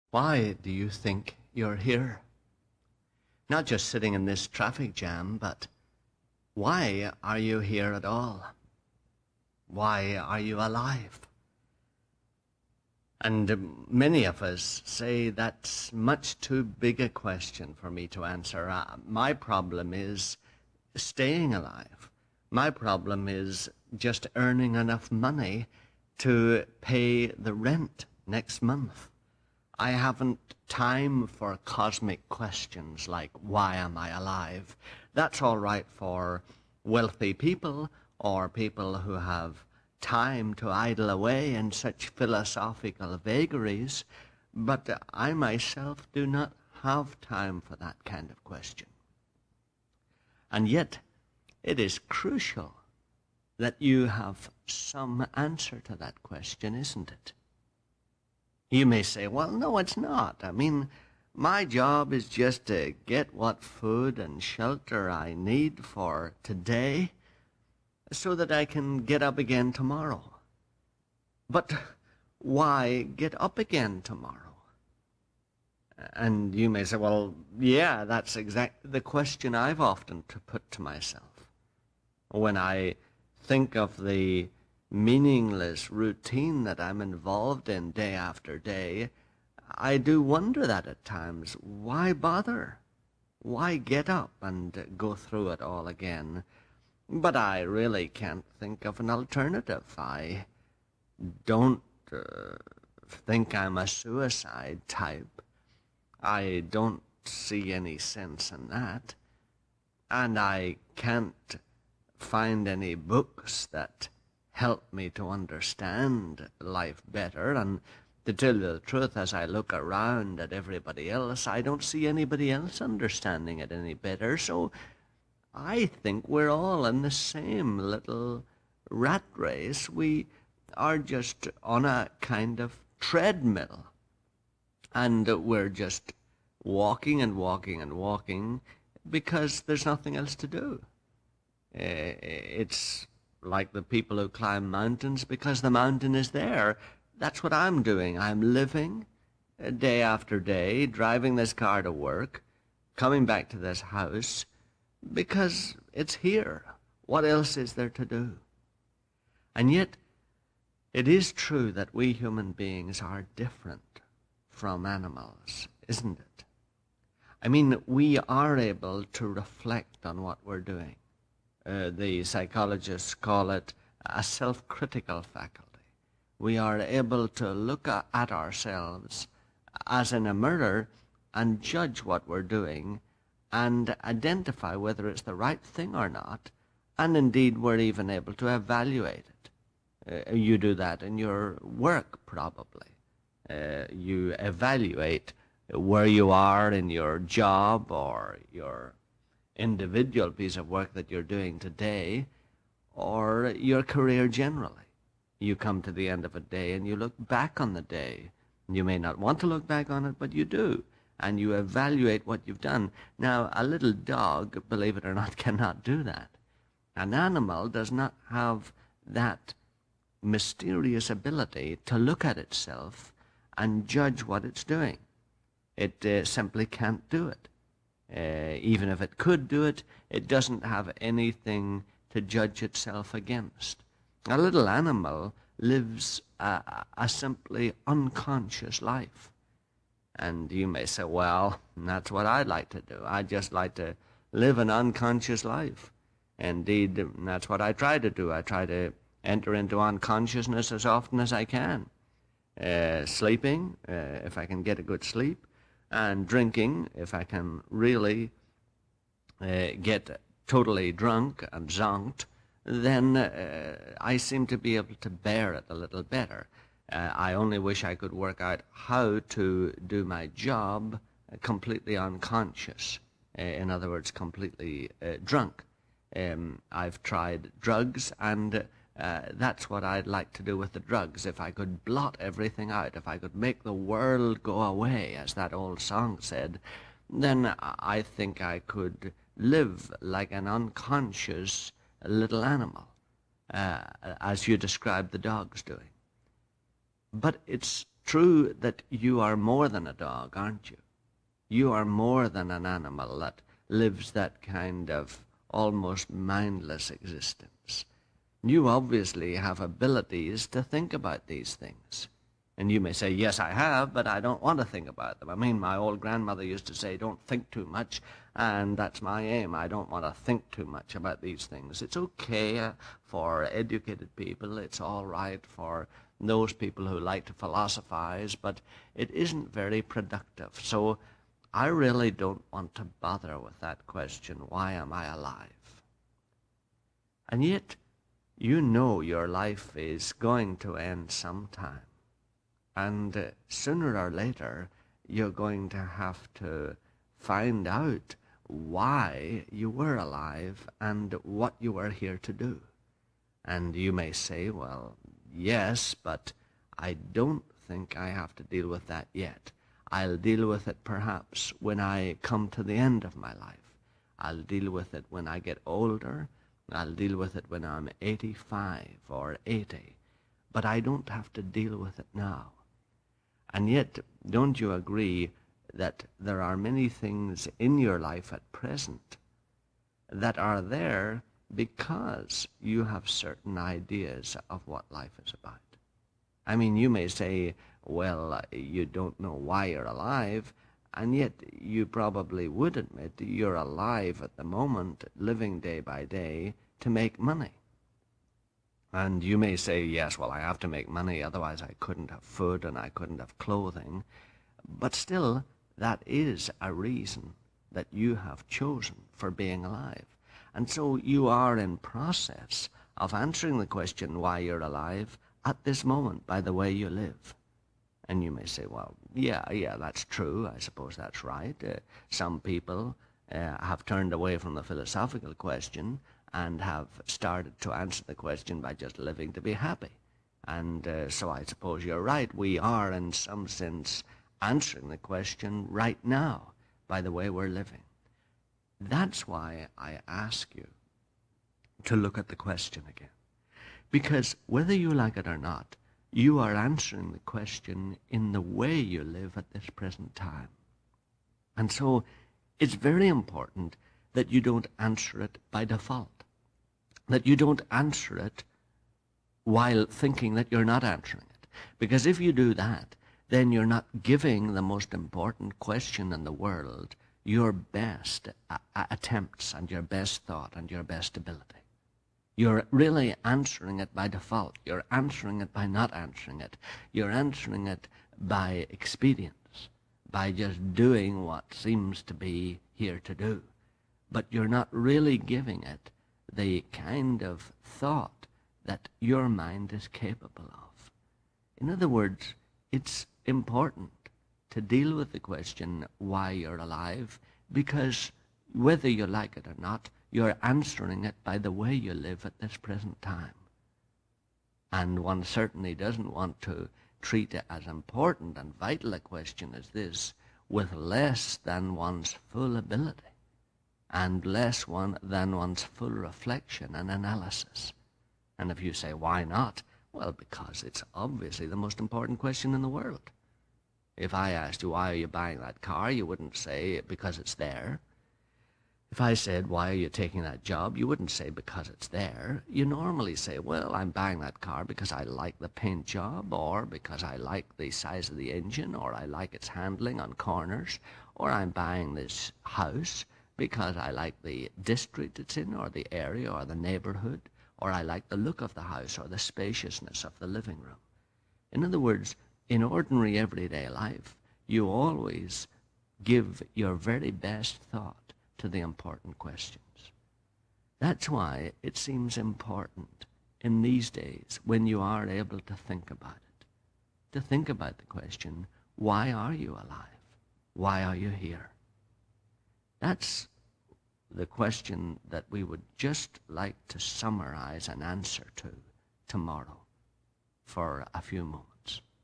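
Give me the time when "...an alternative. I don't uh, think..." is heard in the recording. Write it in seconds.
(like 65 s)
98 s.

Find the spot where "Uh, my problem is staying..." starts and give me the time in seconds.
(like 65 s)
18 s.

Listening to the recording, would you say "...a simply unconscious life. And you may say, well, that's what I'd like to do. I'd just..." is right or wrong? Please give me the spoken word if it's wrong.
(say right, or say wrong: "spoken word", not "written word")
right.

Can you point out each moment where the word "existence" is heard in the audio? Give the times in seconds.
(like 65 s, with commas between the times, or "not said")
306 s.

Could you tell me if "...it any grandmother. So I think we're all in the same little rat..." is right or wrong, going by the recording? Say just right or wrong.
wrong.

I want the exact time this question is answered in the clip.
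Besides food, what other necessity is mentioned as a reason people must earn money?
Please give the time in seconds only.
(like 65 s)
403 s.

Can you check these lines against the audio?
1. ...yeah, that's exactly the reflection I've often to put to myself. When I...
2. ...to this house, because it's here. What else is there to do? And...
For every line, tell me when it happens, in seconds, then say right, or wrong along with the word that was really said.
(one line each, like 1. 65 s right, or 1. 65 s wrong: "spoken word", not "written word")
1. 77 s wrong: "question", not "reflection"
2. 153 s right.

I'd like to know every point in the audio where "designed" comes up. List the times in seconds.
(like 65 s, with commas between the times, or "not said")
not said.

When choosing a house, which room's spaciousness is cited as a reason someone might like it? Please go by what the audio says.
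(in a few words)
living room.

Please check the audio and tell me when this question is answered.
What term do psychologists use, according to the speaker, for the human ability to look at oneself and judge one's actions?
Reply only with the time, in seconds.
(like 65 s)
174 s.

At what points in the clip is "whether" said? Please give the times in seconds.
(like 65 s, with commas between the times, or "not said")
184 s, 444 s, 498 s.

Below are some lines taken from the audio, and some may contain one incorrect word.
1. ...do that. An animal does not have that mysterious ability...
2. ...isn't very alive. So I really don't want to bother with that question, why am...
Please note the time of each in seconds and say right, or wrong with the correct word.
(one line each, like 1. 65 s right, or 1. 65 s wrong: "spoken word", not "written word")
1. 215 s right
2. 329 s wrong: "productive", not "alive".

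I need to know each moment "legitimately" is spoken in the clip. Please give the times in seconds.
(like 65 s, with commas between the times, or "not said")
not said.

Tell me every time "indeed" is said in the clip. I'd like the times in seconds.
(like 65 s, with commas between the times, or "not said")
187 s, 246 s.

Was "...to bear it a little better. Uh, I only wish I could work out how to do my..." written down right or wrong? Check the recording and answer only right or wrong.
right.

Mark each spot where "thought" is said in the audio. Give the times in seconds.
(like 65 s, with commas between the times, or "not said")
470 s, 487 s, 557 s.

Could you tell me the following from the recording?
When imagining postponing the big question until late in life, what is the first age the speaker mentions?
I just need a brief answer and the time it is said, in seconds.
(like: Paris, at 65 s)
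85, at 368 s.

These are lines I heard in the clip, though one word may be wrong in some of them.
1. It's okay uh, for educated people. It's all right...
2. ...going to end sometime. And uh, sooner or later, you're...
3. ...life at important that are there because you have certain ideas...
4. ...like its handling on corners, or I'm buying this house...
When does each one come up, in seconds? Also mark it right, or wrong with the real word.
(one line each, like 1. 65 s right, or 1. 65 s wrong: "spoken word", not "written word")
1. 321 s right
2. 340 s right
3. 377 s wrong: "present", not "important"
4. 539 s right.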